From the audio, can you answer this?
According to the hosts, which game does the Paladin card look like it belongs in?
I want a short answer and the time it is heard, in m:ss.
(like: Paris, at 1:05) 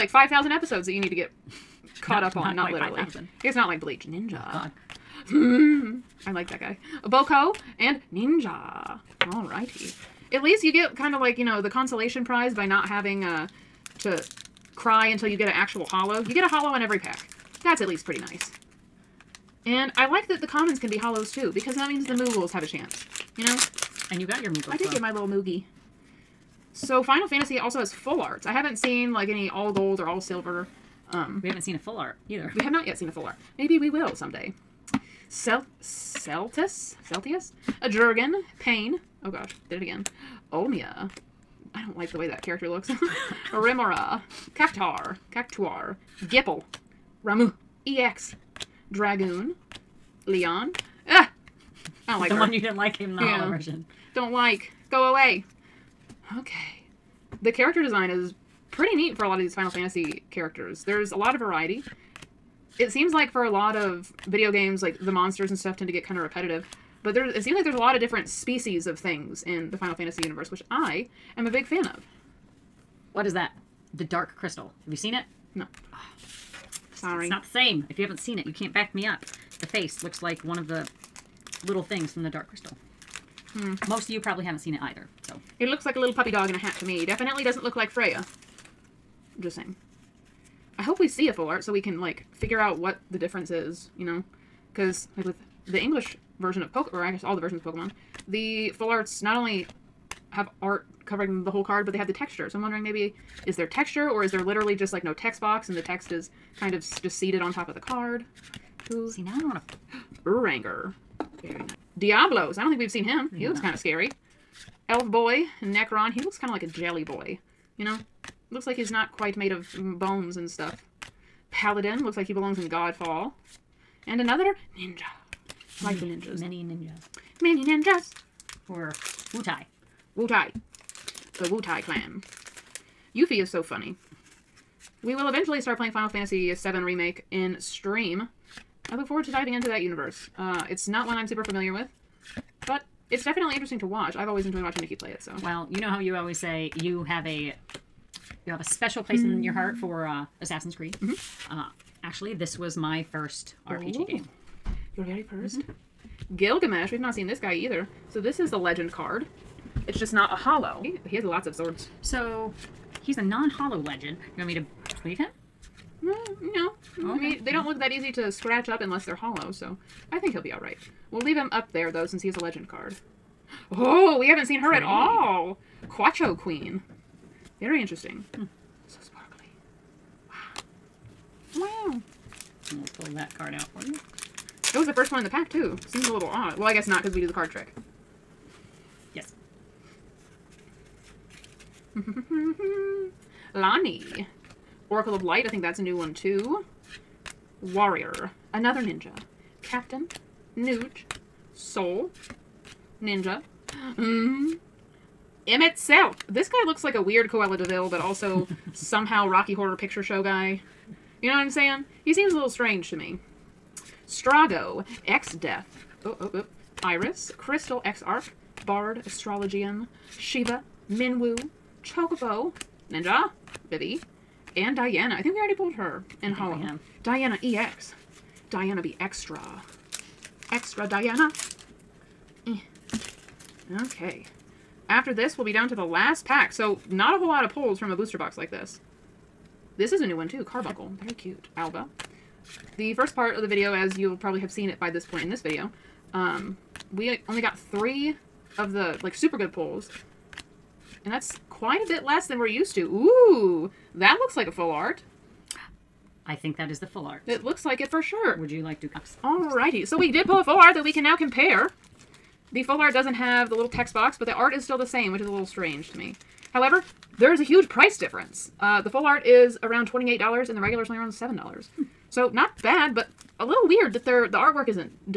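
Godfall, at 2:02.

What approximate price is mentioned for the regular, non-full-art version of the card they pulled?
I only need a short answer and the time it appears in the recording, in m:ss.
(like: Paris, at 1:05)
$7, at 4:31.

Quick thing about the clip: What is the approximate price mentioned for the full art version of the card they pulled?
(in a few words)
$28.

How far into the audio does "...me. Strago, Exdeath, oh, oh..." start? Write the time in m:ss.
3:32.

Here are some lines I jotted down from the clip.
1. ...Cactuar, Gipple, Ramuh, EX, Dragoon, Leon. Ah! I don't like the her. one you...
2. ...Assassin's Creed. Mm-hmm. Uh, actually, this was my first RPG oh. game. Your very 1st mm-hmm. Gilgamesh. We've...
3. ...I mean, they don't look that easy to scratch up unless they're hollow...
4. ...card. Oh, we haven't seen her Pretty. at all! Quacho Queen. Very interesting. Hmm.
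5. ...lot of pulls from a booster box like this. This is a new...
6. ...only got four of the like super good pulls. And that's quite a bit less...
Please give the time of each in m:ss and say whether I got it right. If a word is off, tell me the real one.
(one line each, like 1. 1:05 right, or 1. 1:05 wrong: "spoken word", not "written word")
1. 0:45 right
2. 2:30 right
3. 2:47 right
4. 2:52 right
5. 3:57 right
6. 4:07 wrong: "three", not "four".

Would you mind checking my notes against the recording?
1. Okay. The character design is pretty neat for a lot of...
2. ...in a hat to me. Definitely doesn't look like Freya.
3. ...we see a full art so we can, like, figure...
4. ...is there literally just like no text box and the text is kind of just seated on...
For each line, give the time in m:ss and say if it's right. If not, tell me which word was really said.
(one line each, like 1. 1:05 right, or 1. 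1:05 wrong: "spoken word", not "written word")
1. 0:56 right
2. 1:26 right
3. 1:30 right
4. 1:44 right.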